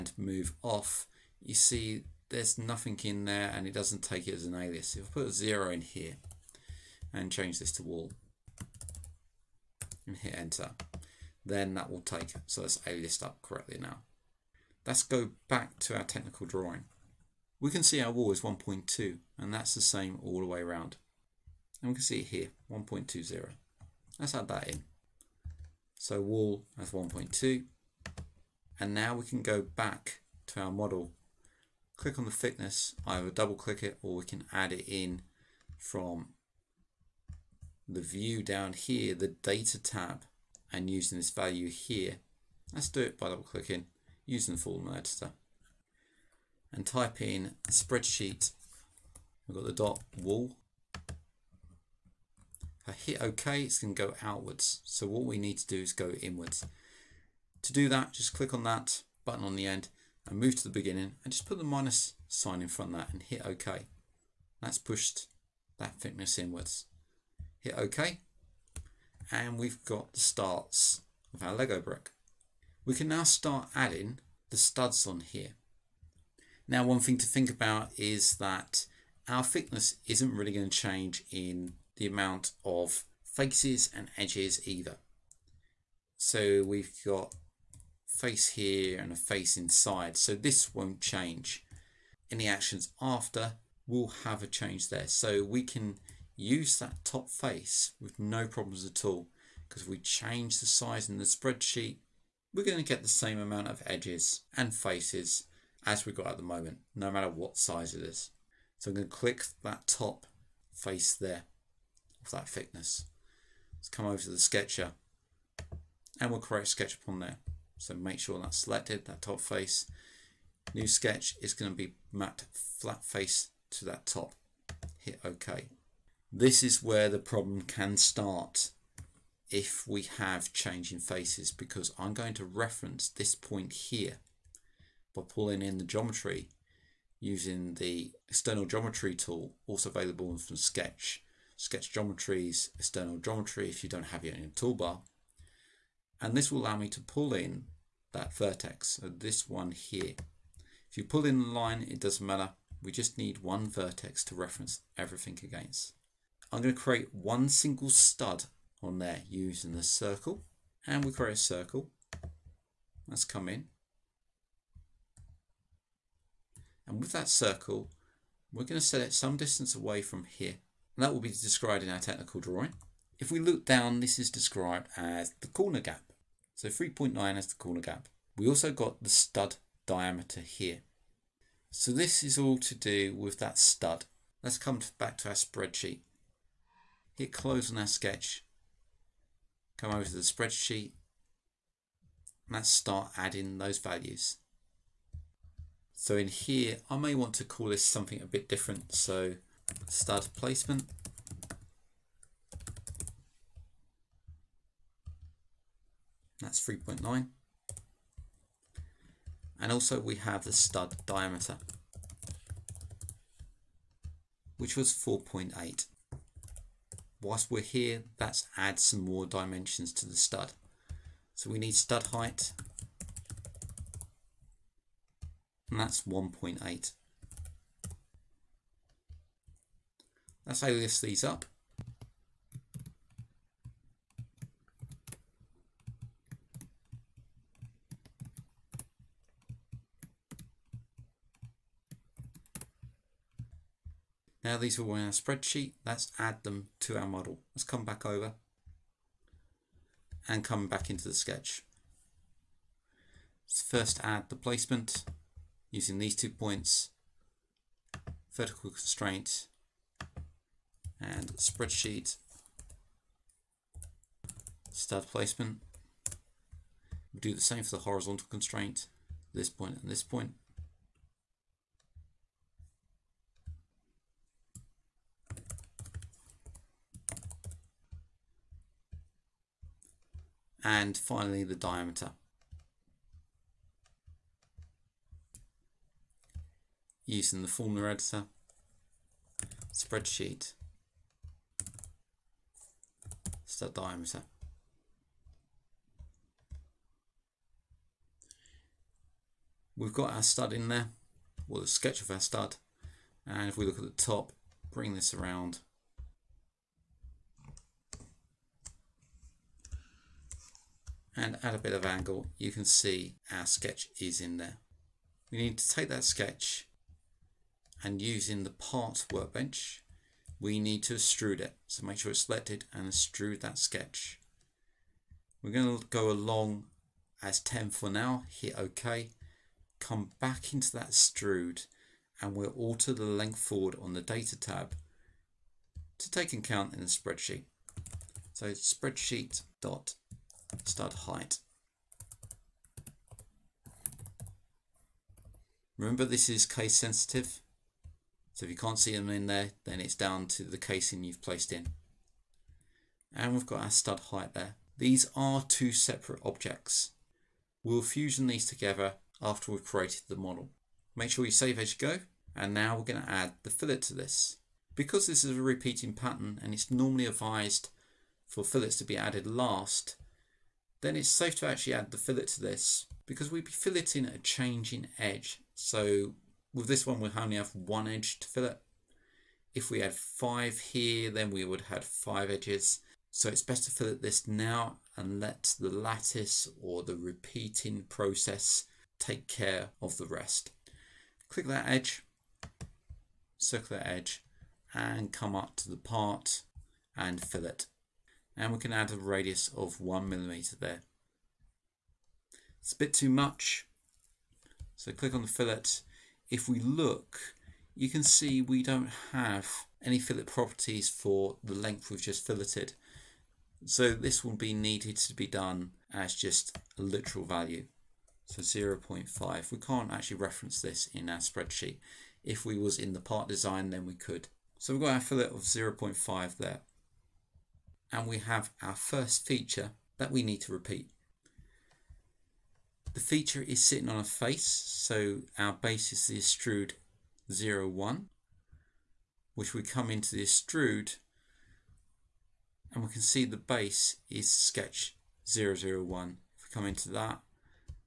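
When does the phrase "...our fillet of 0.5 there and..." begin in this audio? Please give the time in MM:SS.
07:04.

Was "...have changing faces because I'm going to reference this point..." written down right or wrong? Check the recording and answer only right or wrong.
right.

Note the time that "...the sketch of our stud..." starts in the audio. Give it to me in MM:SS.
05:01.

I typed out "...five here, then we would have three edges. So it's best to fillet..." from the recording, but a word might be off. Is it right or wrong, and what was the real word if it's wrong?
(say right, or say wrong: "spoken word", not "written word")
wrong: "five", not "three".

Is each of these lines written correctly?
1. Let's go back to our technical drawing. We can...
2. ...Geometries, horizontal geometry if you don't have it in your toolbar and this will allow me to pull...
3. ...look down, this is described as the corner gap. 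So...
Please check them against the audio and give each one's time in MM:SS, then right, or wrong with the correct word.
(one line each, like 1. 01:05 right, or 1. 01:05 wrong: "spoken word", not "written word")
1. 00:14 right
2. 02:21 wrong: "external", not "horizontal"
3. 02:53 right.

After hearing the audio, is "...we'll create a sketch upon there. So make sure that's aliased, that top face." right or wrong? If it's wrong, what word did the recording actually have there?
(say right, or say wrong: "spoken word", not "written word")
wrong: "selected", not "aliased".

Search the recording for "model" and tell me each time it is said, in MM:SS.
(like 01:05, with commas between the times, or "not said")
00:30, 04:07, 06:00.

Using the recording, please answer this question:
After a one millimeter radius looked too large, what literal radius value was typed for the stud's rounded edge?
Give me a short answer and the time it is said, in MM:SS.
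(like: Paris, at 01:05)
0.5, at 06:58.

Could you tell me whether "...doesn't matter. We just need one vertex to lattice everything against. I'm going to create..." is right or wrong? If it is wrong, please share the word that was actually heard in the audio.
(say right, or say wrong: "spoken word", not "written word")
wrong: "reference", not "lattice".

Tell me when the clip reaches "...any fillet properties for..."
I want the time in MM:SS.
06:49.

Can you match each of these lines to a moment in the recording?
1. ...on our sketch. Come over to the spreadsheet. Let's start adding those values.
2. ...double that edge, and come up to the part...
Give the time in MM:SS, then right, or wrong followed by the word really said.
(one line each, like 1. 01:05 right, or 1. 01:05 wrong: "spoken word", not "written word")
1. 03:07 right
2. 06:33 wrong: "circle", not "double".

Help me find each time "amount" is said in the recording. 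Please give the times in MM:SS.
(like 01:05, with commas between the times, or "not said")
01:22, 01:43.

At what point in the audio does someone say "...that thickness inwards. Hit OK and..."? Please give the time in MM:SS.
01:05.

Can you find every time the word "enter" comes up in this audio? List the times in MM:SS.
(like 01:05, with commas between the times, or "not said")
00:10.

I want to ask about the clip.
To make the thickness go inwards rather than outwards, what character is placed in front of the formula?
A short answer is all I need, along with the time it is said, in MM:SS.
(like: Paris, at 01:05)
minus sign, at 01:01.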